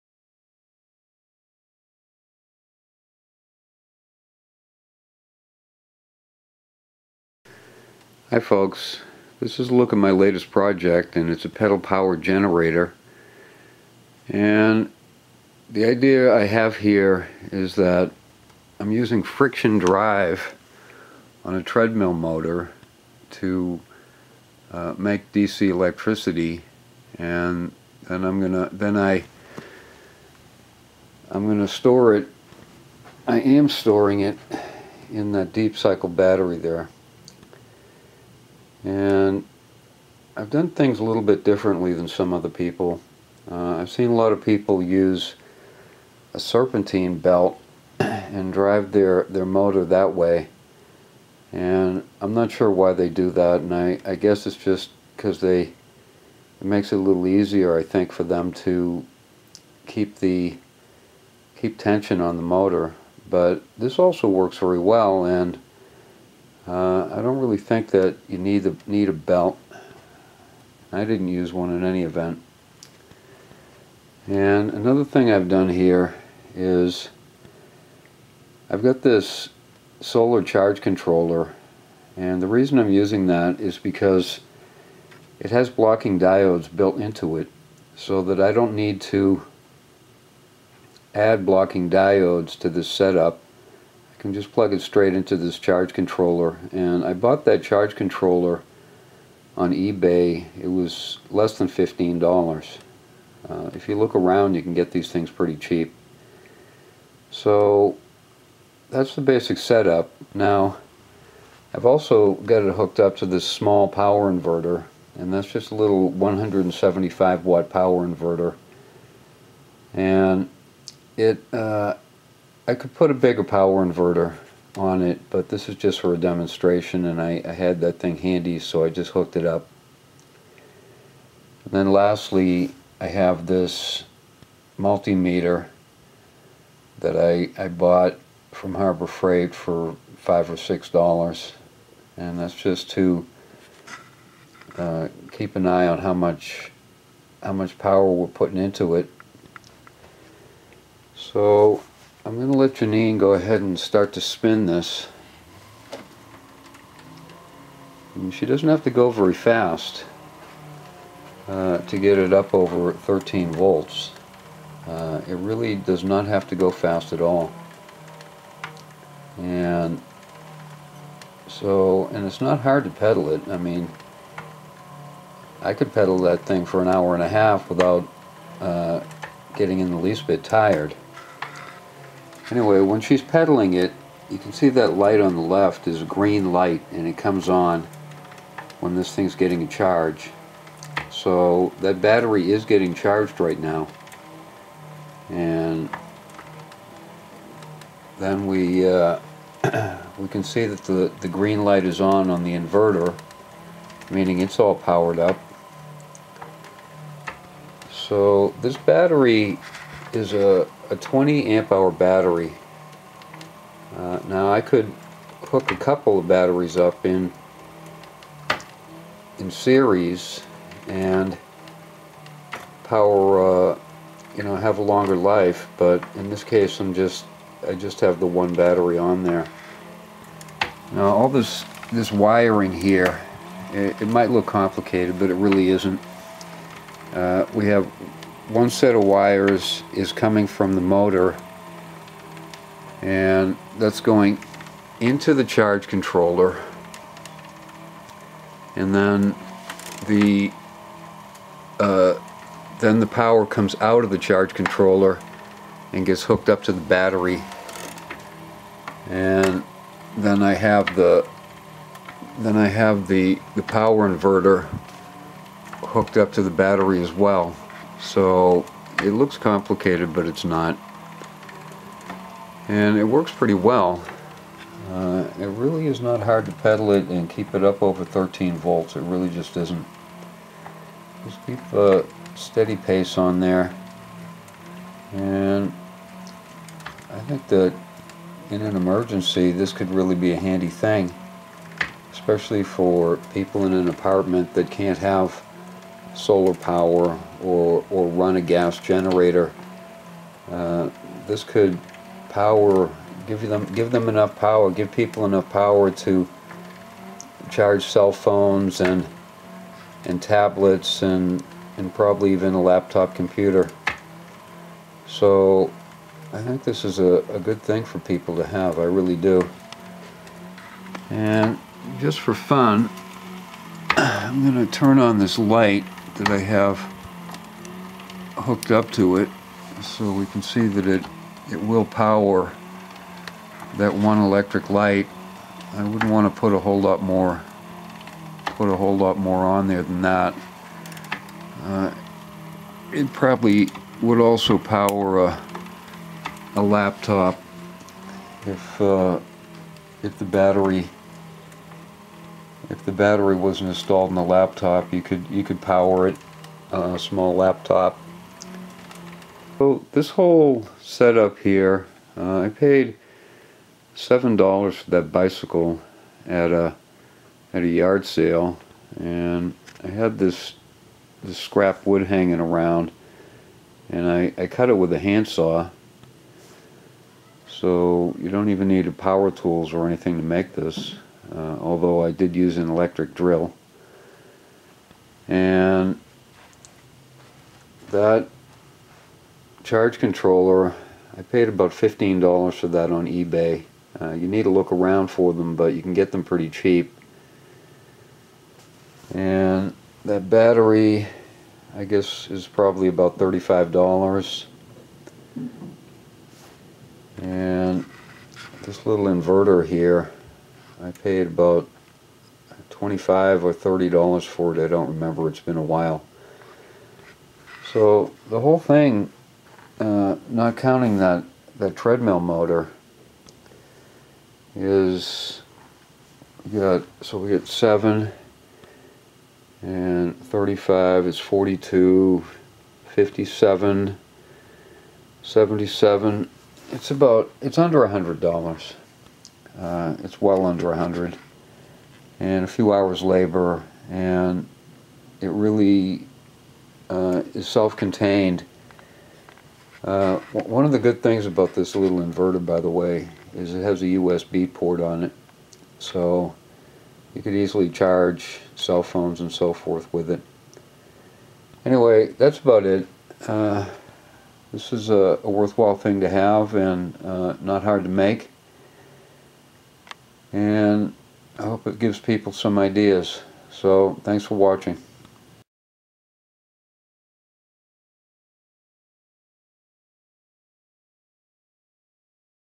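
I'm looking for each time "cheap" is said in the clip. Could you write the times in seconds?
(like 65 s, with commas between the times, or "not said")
105 s, 396 s.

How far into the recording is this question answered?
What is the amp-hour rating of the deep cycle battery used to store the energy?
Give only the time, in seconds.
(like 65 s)
210 s.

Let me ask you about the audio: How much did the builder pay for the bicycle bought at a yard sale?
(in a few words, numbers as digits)
$7.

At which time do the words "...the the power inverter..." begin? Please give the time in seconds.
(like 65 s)
263 s.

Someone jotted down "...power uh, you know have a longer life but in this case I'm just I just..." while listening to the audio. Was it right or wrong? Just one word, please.
right.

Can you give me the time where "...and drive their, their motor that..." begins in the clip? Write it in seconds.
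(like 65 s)
47 s.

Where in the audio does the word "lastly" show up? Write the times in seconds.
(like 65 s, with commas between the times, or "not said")
131 s.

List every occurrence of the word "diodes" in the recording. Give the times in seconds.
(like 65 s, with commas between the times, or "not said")
86 s, 91 s.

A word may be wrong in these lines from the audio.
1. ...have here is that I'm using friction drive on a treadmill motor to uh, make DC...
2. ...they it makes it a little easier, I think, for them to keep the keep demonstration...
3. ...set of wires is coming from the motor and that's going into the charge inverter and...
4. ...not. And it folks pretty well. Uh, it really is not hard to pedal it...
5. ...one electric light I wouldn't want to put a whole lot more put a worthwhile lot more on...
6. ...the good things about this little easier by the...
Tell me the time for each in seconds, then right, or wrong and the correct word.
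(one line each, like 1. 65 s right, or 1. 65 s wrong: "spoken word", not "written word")
1. 16 s right
2. 55 s wrong: "tension", not "demonstration"
3. 238 s wrong: "controller", not "inverter"
4. 270 s wrong: "works", not "folks"
5. 333 s wrong: "whole", not "worthwhile"
6. 450 s wrong: "inverter", not "easier".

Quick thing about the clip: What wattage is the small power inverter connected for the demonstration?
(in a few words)
175 watt.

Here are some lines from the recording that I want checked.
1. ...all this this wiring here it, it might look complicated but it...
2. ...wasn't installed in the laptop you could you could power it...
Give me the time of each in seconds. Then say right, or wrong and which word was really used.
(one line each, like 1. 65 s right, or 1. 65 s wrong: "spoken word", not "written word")
1. 231 s right
2. 353 s right.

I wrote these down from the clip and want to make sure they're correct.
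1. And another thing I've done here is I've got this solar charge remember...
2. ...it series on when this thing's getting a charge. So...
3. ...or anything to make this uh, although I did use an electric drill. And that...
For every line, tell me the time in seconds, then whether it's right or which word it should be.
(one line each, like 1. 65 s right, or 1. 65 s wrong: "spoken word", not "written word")
1. 74 s wrong: "controller", not "remember"
2. 187 s wrong: "comes", not "series"
3. 379 s right.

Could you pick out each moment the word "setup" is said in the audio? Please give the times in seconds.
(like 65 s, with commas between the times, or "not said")
92 s, 109 s, 360 s.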